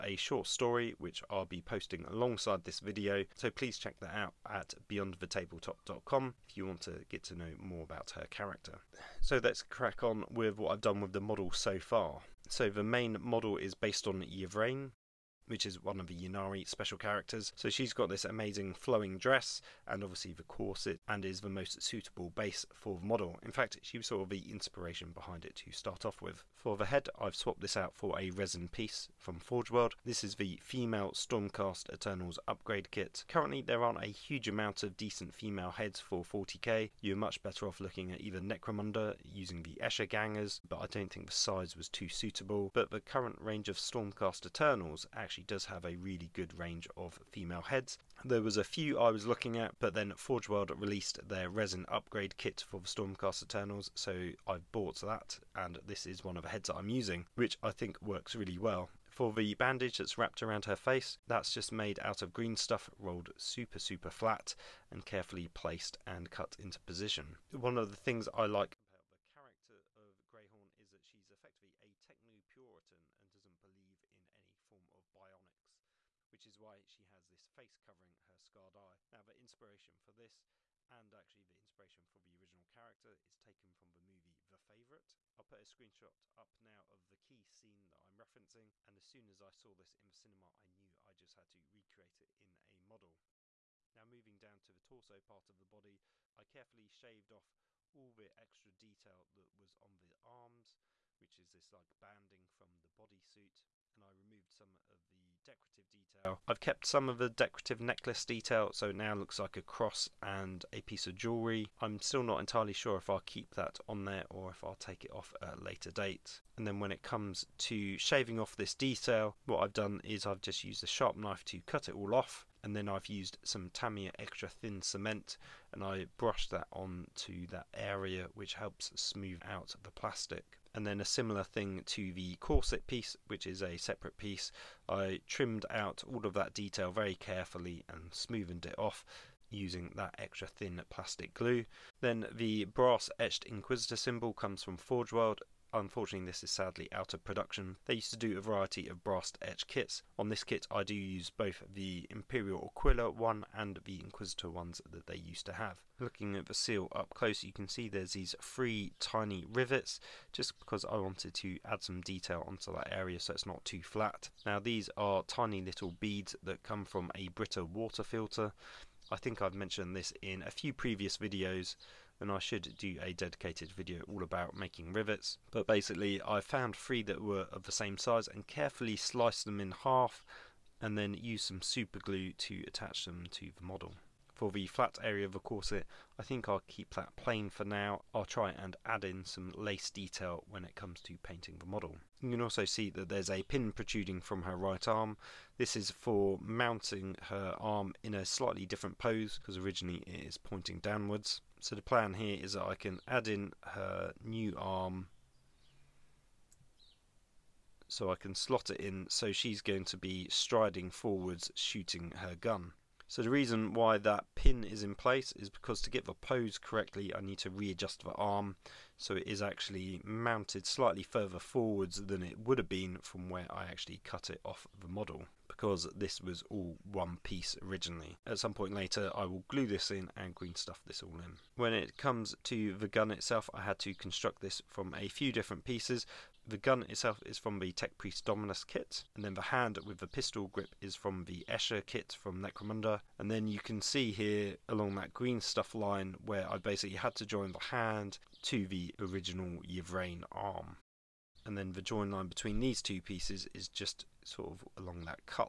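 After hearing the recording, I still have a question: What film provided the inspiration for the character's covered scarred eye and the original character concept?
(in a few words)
The Favourite.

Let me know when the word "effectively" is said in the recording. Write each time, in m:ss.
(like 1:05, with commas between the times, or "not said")
1:11.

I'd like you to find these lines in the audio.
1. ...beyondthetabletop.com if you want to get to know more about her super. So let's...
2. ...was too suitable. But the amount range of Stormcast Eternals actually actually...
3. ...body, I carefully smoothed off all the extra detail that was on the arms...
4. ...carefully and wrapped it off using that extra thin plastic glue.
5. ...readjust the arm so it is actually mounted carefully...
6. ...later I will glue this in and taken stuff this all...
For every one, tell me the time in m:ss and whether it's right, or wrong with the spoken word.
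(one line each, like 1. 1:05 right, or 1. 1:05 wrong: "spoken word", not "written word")
1. 0:04 wrong: "character", not "super"
2. 0:41 wrong: "current", not "amount"
3. 1:35 wrong: "shaved", not "smoothed"
4. 2:17 wrong: "smoothed", not "wrapped"
5. 3:37 wrong: "slightly", not "carefully"
6. 3:48 wrong: "green", not "taken".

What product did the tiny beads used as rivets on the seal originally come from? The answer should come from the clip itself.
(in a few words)
A Brita water filter.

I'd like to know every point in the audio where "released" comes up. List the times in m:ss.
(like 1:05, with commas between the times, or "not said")
0:50.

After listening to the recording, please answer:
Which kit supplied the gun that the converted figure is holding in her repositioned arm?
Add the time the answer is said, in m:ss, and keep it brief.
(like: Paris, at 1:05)
Tech Priest Dominus, at 3:57.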